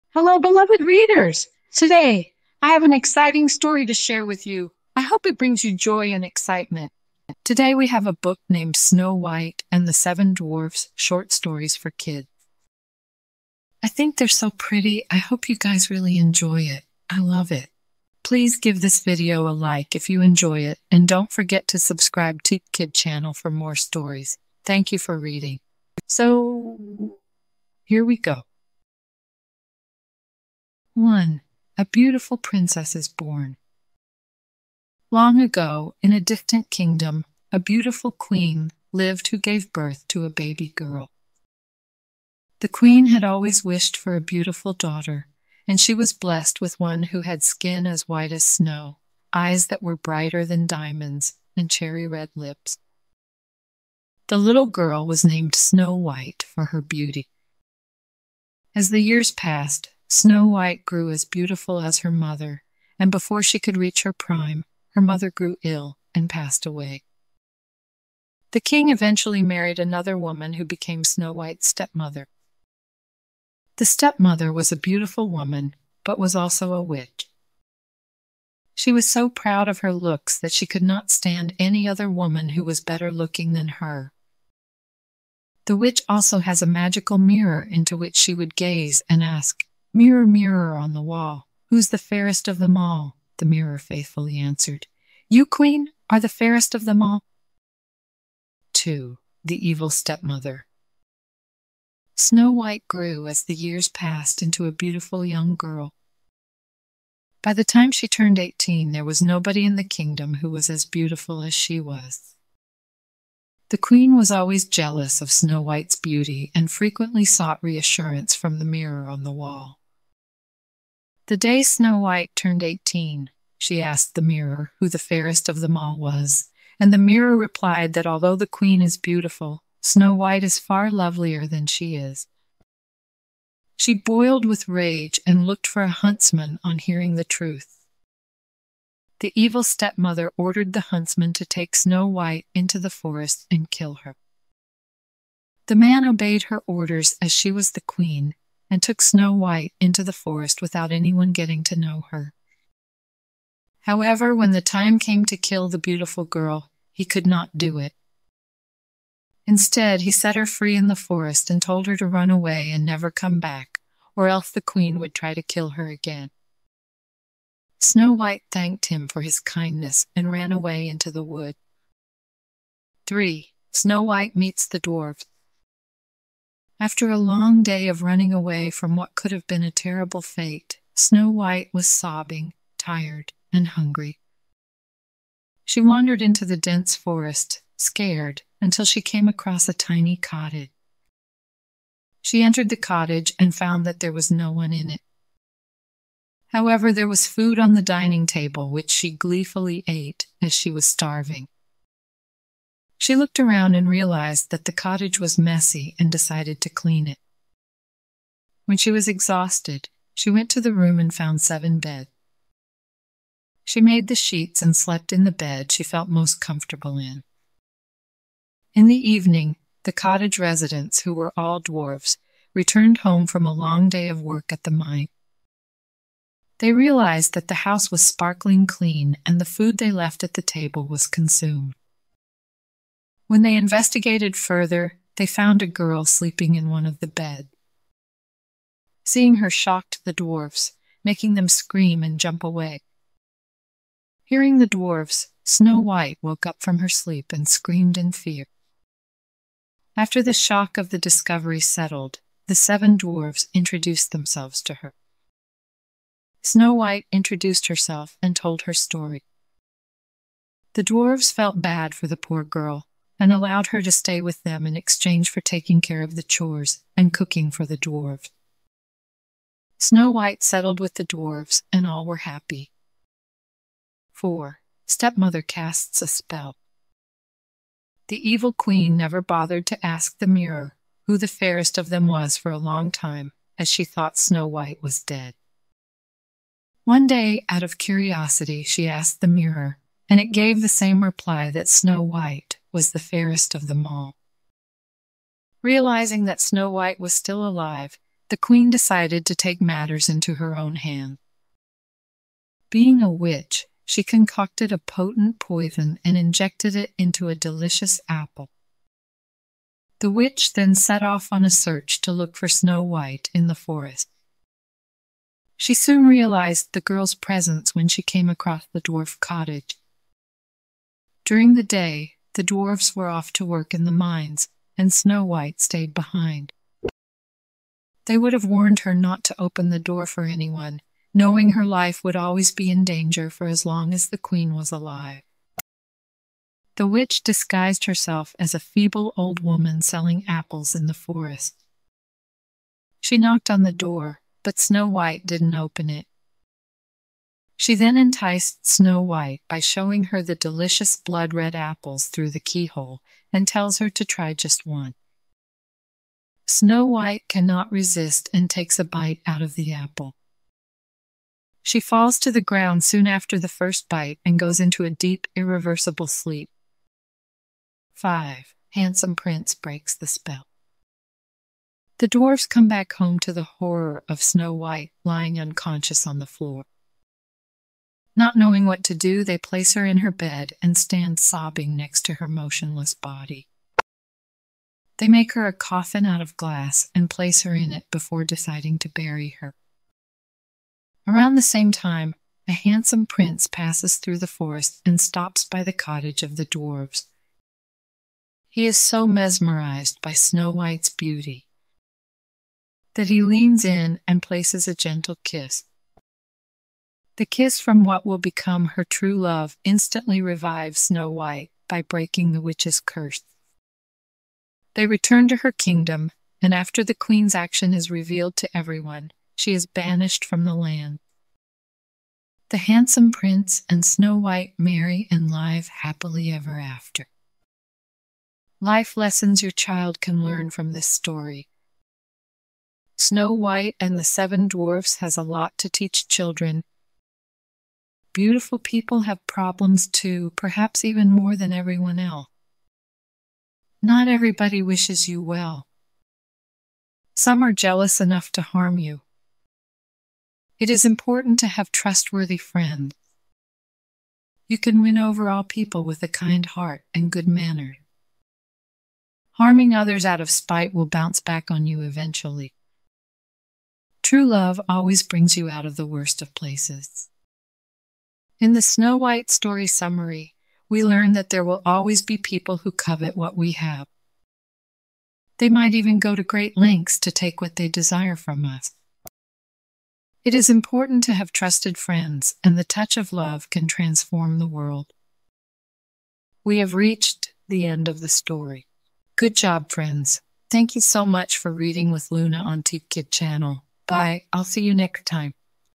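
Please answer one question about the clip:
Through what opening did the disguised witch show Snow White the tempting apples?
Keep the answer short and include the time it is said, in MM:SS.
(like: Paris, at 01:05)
the keyhole, at 05:52.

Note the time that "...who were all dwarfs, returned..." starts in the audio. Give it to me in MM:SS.
03:41.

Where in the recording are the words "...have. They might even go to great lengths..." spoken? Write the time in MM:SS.
07:53.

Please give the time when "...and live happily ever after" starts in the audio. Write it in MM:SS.
07:05.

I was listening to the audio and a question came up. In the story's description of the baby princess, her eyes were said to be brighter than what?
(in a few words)
diamonds.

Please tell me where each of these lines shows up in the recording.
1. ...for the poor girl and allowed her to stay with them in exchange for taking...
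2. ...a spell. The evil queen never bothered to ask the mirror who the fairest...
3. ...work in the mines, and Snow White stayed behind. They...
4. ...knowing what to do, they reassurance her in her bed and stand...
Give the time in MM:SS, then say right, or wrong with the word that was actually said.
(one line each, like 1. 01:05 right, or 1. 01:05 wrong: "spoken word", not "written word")
1. 04:21 right
2. 04:36 right
3. 05:23 right
4. 06:18 wrong: "place", not "reassurance".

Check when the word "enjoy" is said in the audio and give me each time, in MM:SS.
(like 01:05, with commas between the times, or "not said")
00:16, 00:20.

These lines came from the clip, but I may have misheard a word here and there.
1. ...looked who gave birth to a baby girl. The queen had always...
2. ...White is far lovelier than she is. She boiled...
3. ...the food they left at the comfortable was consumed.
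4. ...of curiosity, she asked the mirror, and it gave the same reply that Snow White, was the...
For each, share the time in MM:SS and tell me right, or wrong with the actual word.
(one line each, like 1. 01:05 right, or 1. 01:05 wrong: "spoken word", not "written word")
1. 00:38 wrong: "lived", not "looked"
2. 02:10 right
3. 03:49 wrong: "table", not "comfortable"
4. 04:47 right.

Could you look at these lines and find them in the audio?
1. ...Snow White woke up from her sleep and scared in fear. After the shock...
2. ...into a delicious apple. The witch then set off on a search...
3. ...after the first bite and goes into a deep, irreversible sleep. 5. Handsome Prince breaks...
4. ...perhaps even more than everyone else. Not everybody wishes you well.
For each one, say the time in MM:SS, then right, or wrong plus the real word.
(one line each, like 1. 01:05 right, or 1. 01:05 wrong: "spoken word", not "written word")
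1. 04:05 wrong: "screamed", not "scared"
2. 05:06 right
3. 06:03 right
4. 07:20 right.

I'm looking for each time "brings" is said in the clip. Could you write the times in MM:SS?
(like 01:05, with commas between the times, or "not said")
00:05, 07:45.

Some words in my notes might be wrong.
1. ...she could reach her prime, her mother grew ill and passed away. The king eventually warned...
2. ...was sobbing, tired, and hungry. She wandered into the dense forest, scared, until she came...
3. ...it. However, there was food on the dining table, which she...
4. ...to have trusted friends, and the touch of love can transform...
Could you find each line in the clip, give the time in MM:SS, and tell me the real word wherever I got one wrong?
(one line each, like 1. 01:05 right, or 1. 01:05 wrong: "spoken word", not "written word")
1. 01:03 wrong: "married", not "warned"
2. 03:01 right
3. 03:14 right
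4. 08:01 right.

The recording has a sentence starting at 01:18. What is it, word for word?
She was so proud of her looks that she could not stand any other woman who was better looking than her.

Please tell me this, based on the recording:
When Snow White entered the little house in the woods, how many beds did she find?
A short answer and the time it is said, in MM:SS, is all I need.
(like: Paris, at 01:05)
7, at 03:31.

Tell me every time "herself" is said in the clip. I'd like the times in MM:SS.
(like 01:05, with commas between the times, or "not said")
04:17, 05:37.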